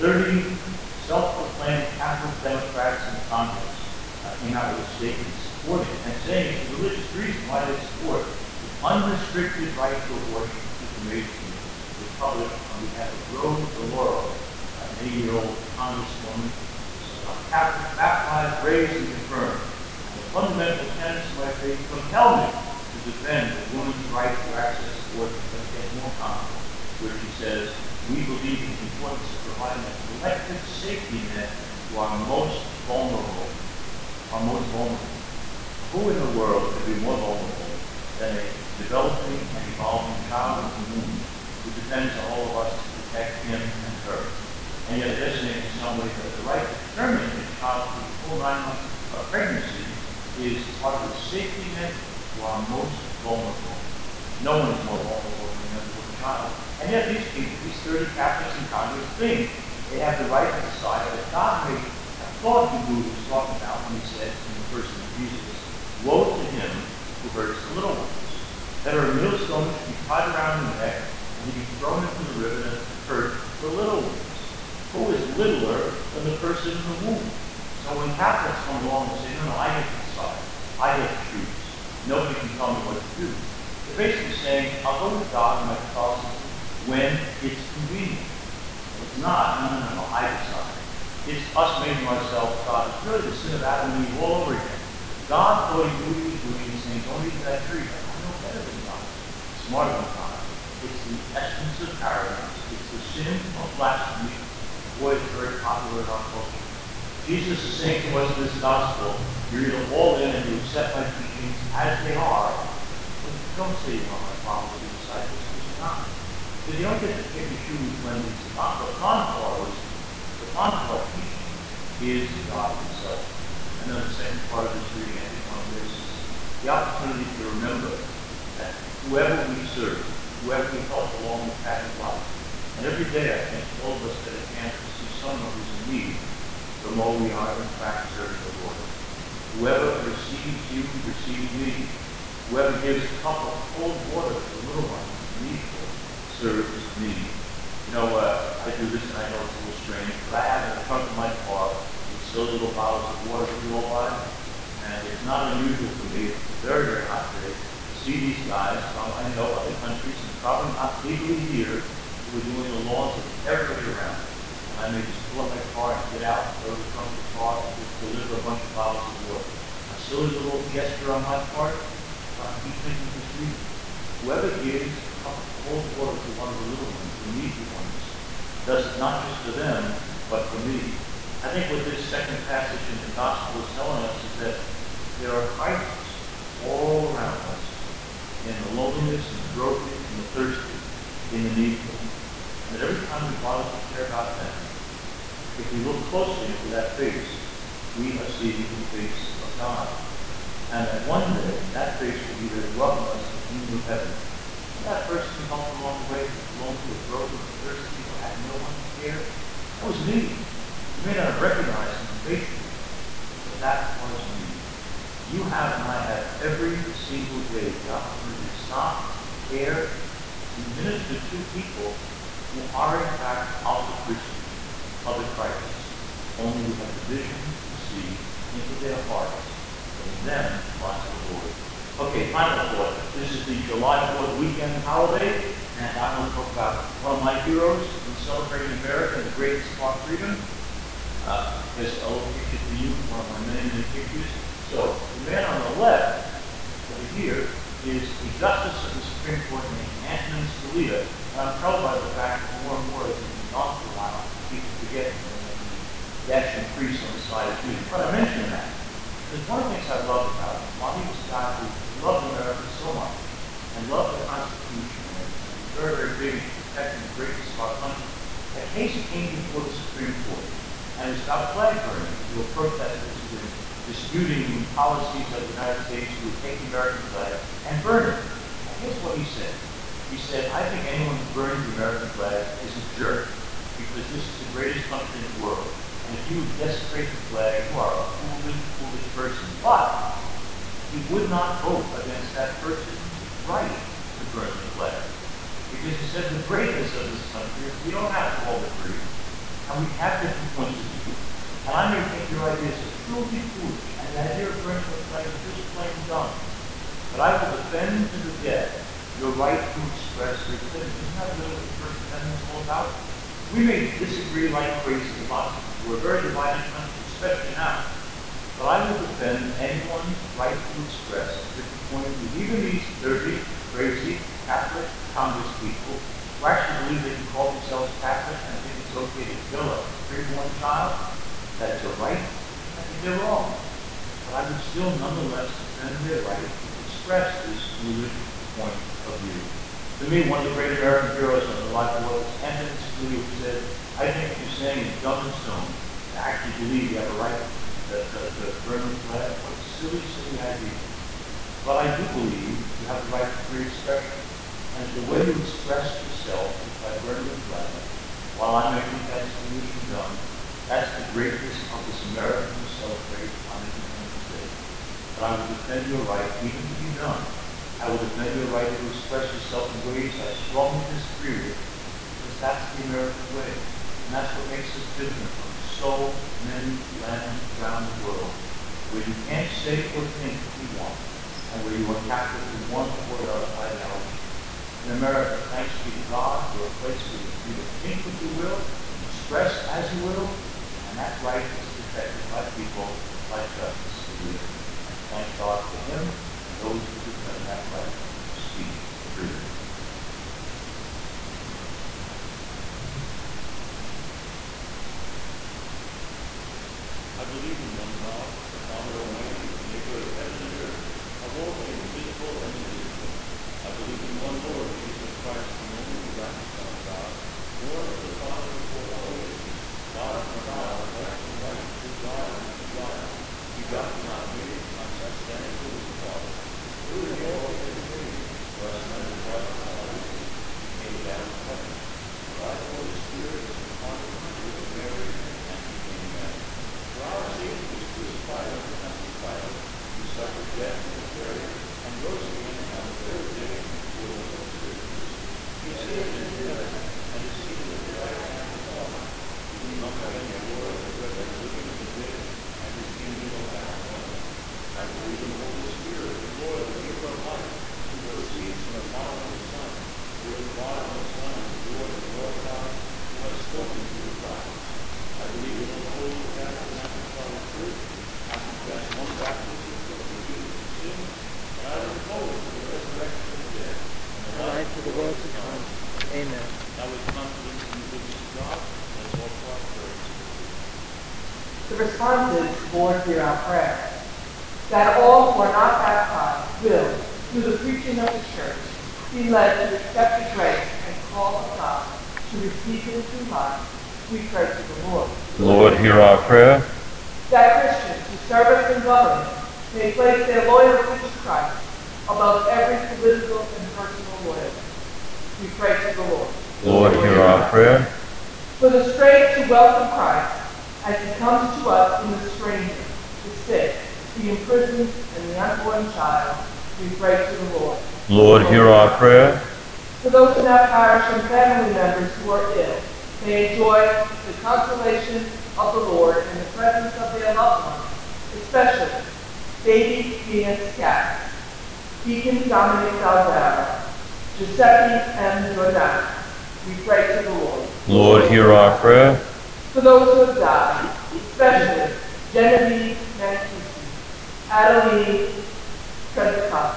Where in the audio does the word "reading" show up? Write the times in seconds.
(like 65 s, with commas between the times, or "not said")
124 s, 173 s.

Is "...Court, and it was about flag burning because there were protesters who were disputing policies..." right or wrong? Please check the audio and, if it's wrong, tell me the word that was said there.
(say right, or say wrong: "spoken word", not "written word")
right.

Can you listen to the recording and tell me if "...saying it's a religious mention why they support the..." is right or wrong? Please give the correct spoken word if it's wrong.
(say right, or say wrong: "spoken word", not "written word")
wrong: "reason", not "mention".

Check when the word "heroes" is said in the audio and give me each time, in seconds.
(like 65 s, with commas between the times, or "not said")
237 s, 341 s.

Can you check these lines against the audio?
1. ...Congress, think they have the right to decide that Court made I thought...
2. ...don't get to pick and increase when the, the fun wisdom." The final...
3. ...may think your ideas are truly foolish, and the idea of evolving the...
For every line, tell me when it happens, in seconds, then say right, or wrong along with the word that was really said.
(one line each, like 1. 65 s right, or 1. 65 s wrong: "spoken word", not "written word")
1. 58 s wrong: "God", not "Court"
2. 116 s wrong: "choose", not "increase"
3. 302 s wrong: "burning", not "evolving".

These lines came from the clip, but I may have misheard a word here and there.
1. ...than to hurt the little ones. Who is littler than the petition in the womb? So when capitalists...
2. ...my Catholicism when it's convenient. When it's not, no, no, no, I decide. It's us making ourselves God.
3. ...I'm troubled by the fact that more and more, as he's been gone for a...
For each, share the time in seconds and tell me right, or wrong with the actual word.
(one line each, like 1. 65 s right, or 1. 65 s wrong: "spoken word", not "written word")
1. 72 s wrong: "person", not "petition"
2. 85 s right
3. 251 s right.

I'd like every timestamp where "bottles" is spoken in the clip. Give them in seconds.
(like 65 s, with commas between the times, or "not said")
152 s, 168 s.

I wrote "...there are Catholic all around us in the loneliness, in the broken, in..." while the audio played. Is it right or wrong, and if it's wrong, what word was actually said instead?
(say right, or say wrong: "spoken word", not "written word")
wrong: "Christs", not "Catholic".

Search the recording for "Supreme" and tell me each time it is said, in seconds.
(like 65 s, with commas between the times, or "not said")
249 s, 269 s.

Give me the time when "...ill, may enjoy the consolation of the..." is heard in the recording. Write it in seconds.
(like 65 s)
522 s.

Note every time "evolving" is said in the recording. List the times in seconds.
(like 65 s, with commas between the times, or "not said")
39 s.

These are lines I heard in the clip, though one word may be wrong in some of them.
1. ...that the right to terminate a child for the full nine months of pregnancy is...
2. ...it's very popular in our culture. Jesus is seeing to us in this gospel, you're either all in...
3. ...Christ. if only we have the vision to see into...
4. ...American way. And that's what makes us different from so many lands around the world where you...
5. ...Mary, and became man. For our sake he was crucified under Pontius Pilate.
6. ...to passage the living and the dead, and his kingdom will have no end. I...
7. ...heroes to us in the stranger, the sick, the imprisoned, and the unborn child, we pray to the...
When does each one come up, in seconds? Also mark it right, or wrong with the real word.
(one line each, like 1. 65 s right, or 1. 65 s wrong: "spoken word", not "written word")
1. 46 s right
2. 105 s wrong: "saying", not "seeing"
3. 225 s right
4. 372 s right
5. 434 s right
6. 450 s wrong: "judge", not "passage"
7. 511 s wrong: "comes", not "heroes".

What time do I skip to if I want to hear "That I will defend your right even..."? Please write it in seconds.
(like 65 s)
365 s.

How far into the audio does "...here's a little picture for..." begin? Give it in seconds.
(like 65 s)
241 s.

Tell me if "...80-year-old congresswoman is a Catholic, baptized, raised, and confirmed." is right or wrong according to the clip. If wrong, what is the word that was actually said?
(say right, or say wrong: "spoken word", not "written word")
right.